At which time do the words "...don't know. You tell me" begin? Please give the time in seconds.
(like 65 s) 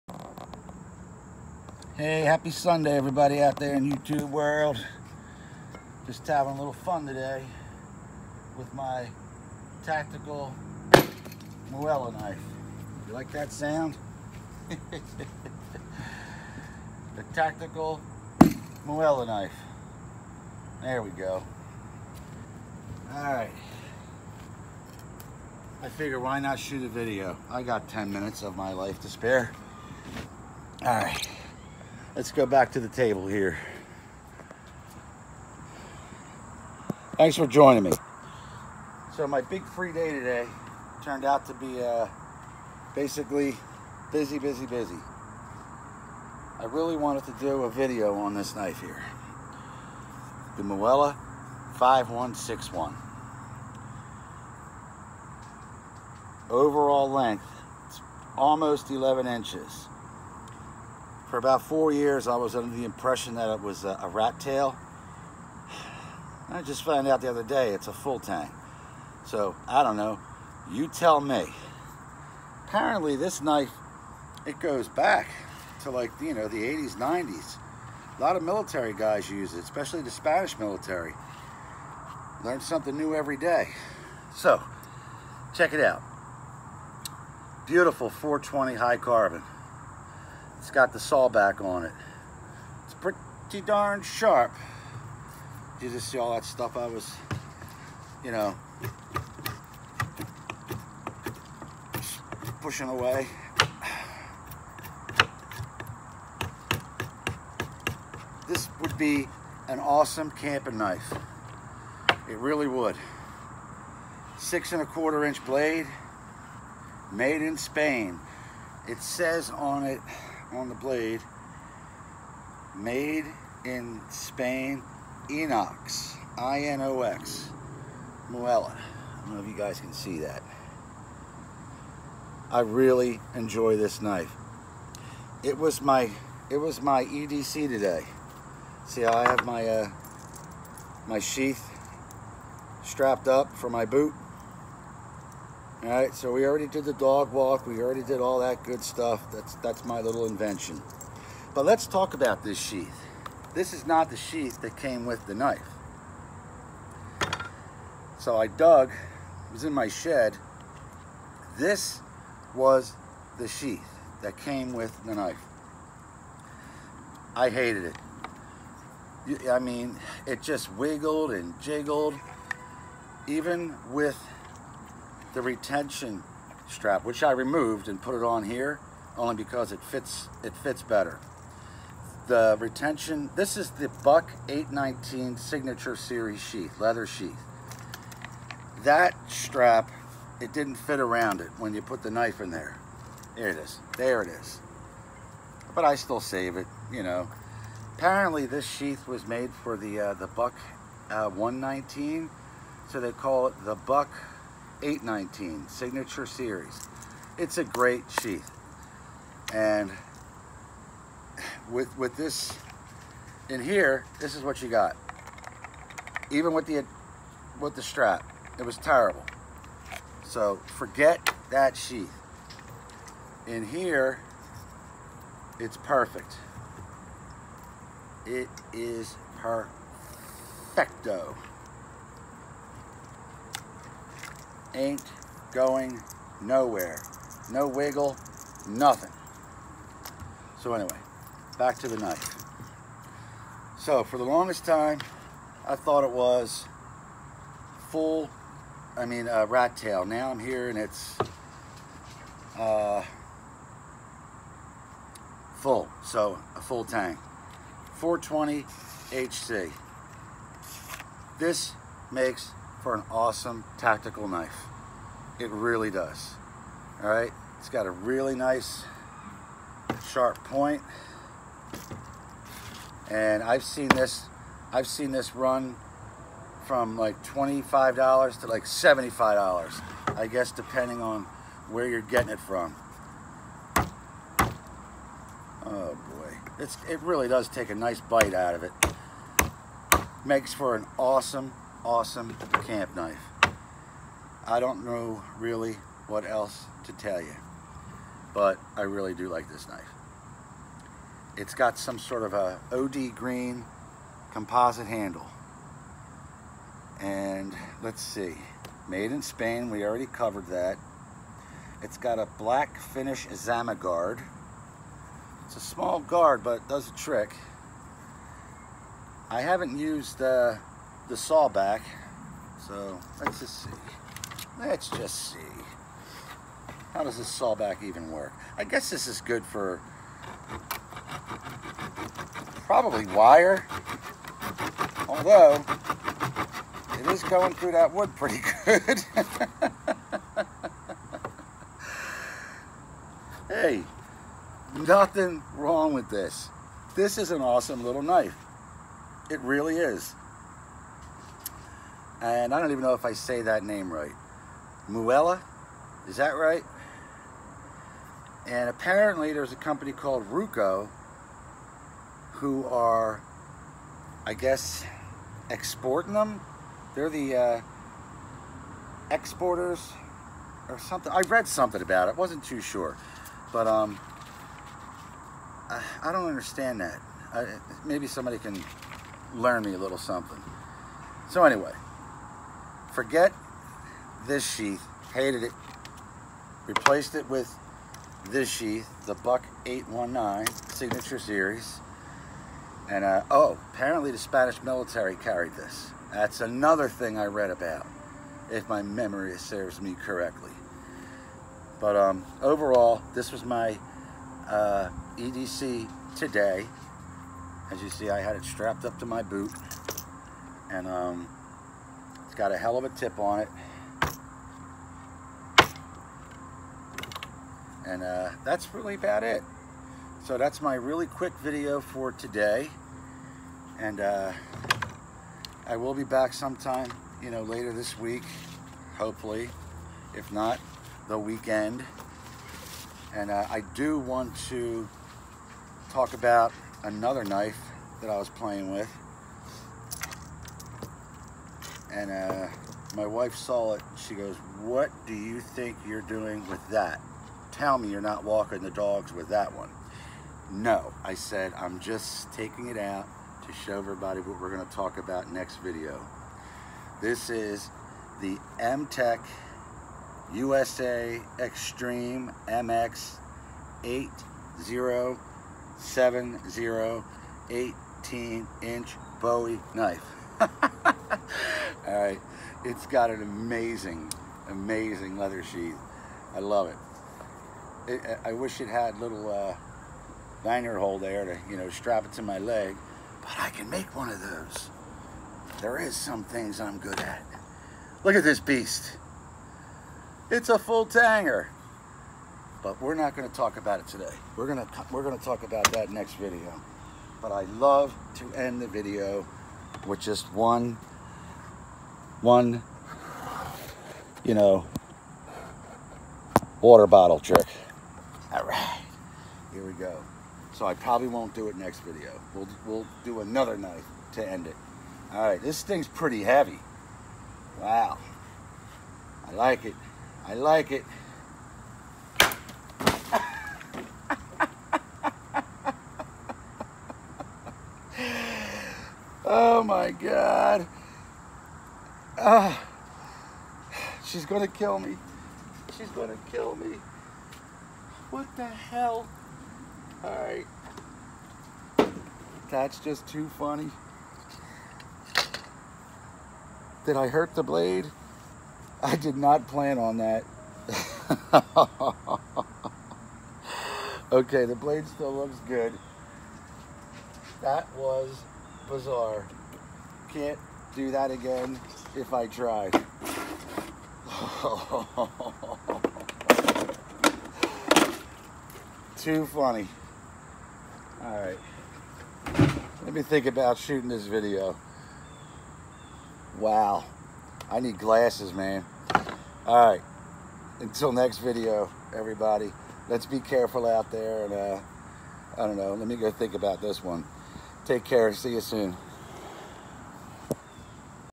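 69 s.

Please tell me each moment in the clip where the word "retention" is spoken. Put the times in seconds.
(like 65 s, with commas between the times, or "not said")
175 s, 182 s.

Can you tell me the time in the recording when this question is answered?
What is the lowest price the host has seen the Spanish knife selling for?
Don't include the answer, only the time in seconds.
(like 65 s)
277 s.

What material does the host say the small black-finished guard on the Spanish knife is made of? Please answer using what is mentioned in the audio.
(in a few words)
Zama.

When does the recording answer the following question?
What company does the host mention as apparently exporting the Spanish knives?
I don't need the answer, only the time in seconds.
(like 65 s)
360 s.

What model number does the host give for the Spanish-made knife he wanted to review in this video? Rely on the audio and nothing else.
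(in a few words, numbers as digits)
5161.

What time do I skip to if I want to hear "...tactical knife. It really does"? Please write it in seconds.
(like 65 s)
263 s.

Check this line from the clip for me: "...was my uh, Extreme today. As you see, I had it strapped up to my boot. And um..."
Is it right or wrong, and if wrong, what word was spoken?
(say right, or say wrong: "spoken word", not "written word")
wrong: "EDC", not "Extreme".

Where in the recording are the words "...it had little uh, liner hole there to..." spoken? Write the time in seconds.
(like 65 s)
478 s.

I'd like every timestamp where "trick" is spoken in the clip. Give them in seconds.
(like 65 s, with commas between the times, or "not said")
316 s, 507 s.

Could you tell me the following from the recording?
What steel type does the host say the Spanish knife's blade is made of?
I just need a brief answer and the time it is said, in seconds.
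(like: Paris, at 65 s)
420 high carbon, at 88 s.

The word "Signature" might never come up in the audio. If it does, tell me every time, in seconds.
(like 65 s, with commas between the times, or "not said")
185 s, 205 s, 390 s.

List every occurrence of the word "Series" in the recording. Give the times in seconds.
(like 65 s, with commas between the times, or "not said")
185 s, 206 s, 391 s.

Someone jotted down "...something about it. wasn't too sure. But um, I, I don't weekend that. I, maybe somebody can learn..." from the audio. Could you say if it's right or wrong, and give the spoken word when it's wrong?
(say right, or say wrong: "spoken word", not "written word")
wrong: "understand", not "weekend".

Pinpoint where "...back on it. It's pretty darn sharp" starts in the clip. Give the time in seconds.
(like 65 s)
91 s.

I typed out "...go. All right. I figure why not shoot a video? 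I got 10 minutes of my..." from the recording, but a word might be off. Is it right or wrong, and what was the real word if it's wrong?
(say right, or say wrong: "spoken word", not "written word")
right.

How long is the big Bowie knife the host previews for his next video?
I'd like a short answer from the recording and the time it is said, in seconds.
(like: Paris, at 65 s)
18 inches, at 467 s.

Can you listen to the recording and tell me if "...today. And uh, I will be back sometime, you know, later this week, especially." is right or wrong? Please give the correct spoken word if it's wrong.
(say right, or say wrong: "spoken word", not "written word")
wrong: "hopefully", not "especially".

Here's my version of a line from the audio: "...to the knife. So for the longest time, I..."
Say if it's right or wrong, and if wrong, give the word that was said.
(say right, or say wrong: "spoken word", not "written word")
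right.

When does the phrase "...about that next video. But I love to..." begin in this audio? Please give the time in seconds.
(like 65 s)
495 s.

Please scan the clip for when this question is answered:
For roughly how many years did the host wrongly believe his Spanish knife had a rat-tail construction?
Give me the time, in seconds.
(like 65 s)
61 s.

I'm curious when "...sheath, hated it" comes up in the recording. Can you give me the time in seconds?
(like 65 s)
384 s.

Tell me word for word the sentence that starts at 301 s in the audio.
It's got some sort of a OD green composite handle.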